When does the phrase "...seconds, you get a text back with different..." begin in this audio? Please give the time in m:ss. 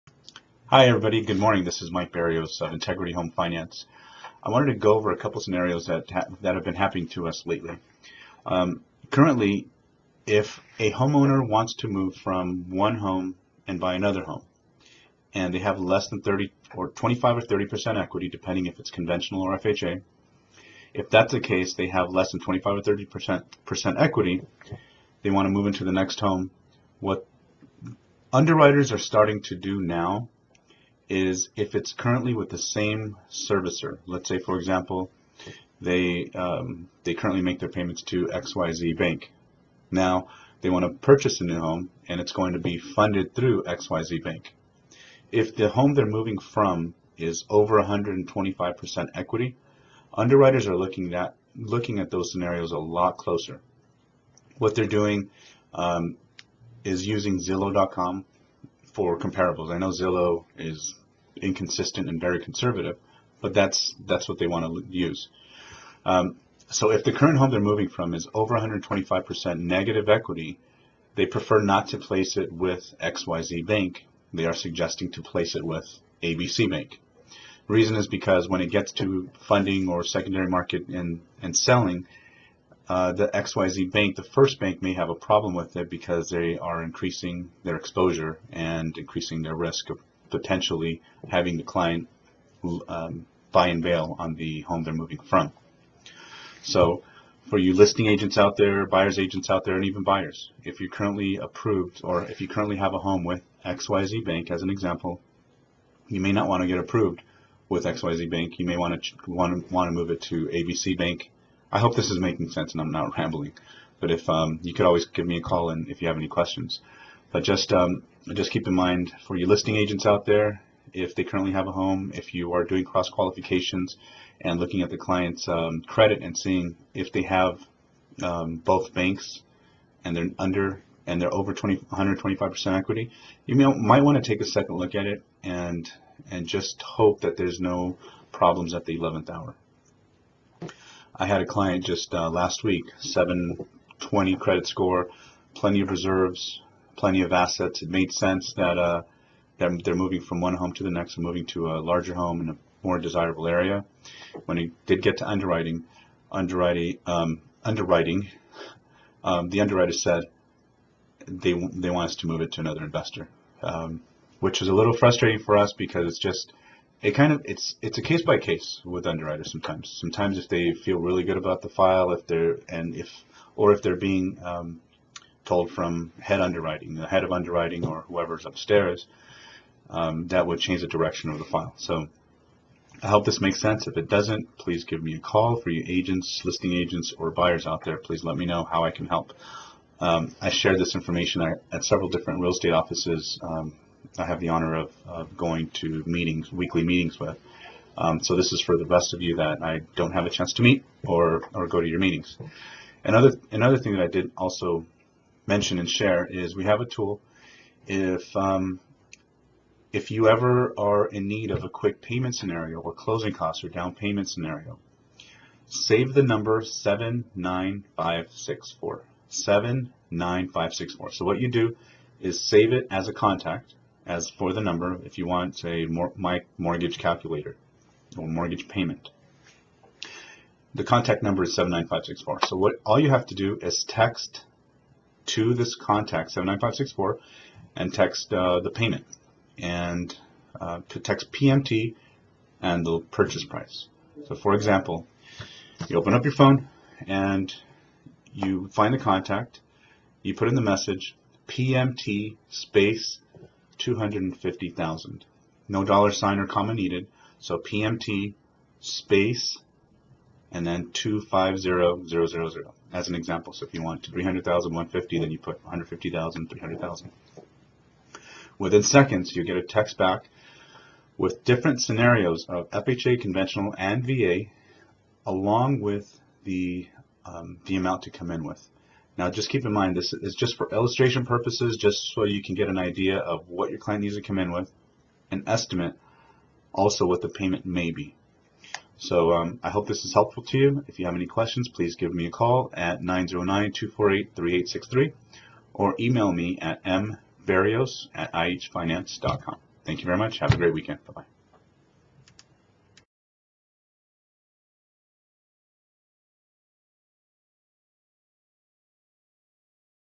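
4:28.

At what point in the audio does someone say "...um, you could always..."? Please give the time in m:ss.
1:54.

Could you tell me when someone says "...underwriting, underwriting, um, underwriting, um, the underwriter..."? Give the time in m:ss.
2:35.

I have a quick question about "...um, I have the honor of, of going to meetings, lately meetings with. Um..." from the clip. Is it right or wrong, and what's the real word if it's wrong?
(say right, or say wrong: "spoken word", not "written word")
wrong: "weekly", not "lately".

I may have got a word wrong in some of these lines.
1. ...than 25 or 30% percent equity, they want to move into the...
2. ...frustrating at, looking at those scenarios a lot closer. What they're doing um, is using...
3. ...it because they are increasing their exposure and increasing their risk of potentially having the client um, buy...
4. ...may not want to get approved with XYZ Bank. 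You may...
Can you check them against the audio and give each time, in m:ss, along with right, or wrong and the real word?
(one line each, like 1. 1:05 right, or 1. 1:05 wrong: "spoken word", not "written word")
1. 0:22 right
2. 0:50 wrong: "looking", not "frustrating"
3. 1:25 right
4. 1:46 right.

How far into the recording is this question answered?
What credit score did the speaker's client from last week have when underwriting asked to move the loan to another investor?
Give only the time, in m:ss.
2:22.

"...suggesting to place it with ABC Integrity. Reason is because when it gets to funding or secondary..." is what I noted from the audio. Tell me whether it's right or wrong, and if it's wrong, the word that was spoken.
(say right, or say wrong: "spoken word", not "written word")
wrong: "Bank", not "Integrity".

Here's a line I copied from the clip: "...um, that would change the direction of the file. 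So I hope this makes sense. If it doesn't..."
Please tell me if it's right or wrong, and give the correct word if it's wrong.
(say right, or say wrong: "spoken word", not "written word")
right.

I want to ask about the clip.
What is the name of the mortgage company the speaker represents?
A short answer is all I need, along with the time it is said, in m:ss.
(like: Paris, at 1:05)
Integrity Home Finance, at 0:02.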